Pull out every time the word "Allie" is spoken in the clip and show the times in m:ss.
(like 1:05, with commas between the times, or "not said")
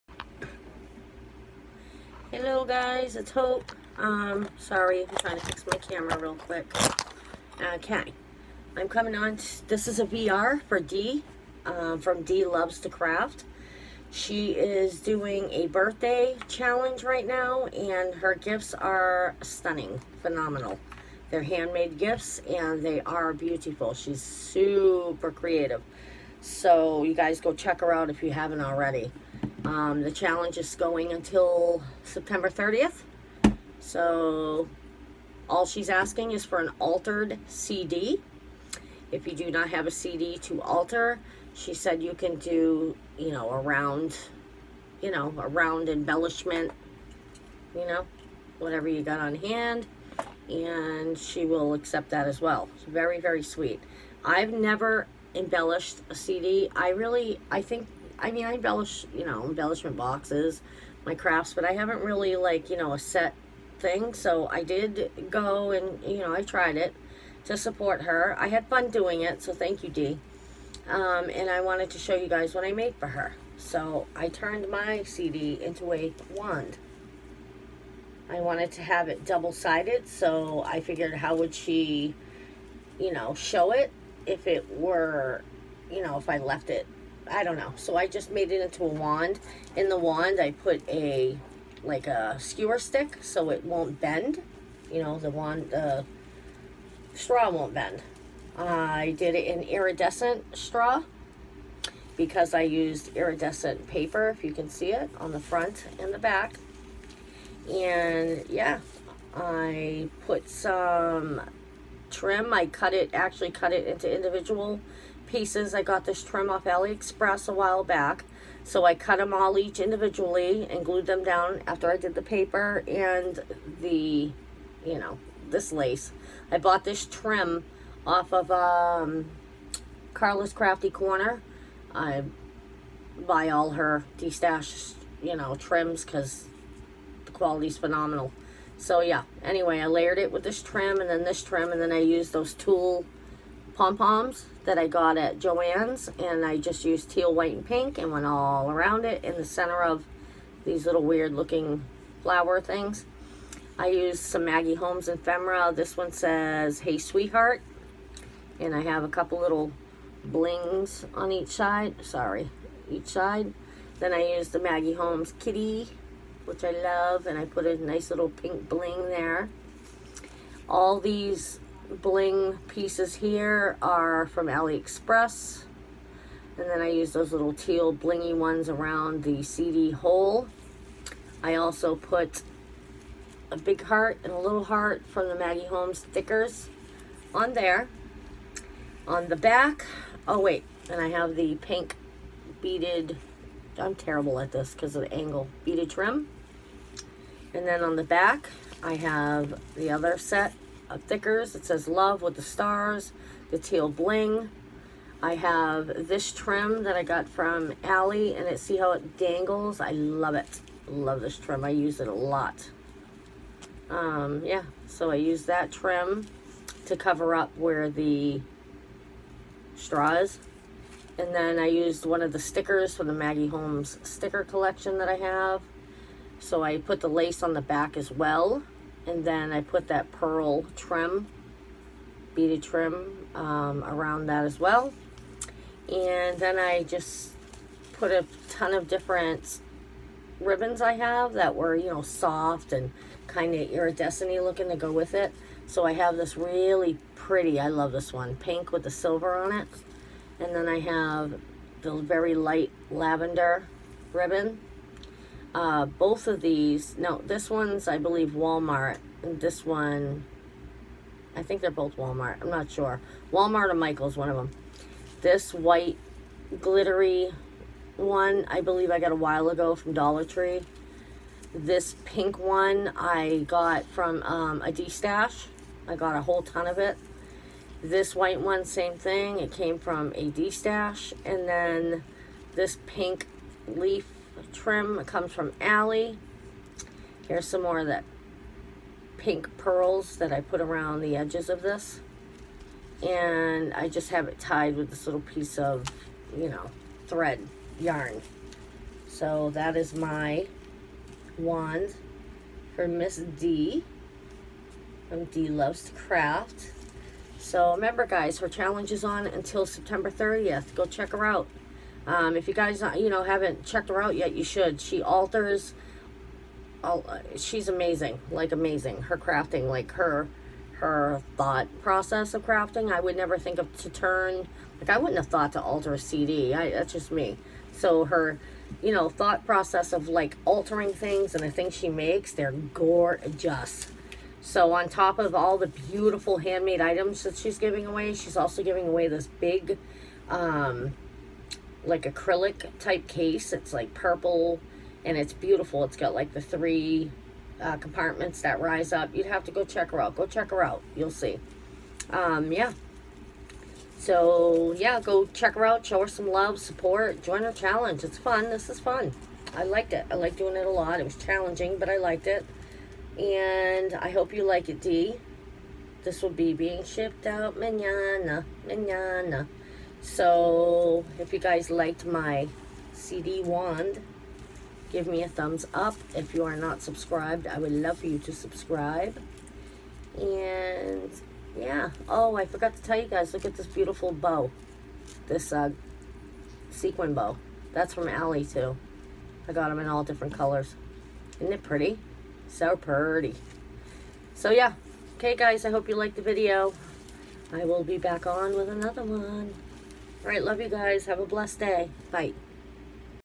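3:27, 4:45, 6:28.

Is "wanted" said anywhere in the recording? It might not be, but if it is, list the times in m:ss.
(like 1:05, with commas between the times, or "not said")
1:11, 1:18.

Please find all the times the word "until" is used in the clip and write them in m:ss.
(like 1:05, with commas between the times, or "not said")
0:31, 5:09.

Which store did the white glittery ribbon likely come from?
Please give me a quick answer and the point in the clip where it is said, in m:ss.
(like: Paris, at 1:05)
Dollar Tree, at 4:29.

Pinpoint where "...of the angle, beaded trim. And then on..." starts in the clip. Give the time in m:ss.
3:14.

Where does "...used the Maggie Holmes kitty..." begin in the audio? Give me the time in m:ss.
2:44.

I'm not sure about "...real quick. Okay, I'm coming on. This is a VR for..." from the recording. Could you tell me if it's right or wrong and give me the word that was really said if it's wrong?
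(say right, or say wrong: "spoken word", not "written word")
right.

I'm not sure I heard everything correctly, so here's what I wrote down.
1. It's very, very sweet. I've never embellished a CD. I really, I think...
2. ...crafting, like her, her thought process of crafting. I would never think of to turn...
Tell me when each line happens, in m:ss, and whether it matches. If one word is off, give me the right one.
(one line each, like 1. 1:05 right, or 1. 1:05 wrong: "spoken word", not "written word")
1. 0:52 right
2. 5:19 right.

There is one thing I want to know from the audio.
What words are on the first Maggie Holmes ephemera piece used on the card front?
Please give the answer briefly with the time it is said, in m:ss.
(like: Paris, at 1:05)
Hey Sweetheart, at 2:36.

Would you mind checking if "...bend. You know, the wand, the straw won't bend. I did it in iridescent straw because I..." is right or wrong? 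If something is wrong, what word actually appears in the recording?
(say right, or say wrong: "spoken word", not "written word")
right.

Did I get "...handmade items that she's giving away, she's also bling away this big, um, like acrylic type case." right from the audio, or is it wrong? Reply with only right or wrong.
wrong.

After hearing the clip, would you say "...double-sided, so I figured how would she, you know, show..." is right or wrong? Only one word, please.
right.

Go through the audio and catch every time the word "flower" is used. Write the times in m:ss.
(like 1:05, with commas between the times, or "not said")
2:32.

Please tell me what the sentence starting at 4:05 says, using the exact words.
So I have this really pretty, I love this one, pink with the silver on it.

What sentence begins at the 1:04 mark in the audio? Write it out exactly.
So I did go and, you know, I tried it to support her.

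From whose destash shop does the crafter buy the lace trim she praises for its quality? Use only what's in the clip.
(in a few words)
Carla's Crafty Corner.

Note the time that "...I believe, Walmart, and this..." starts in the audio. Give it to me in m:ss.
4:17.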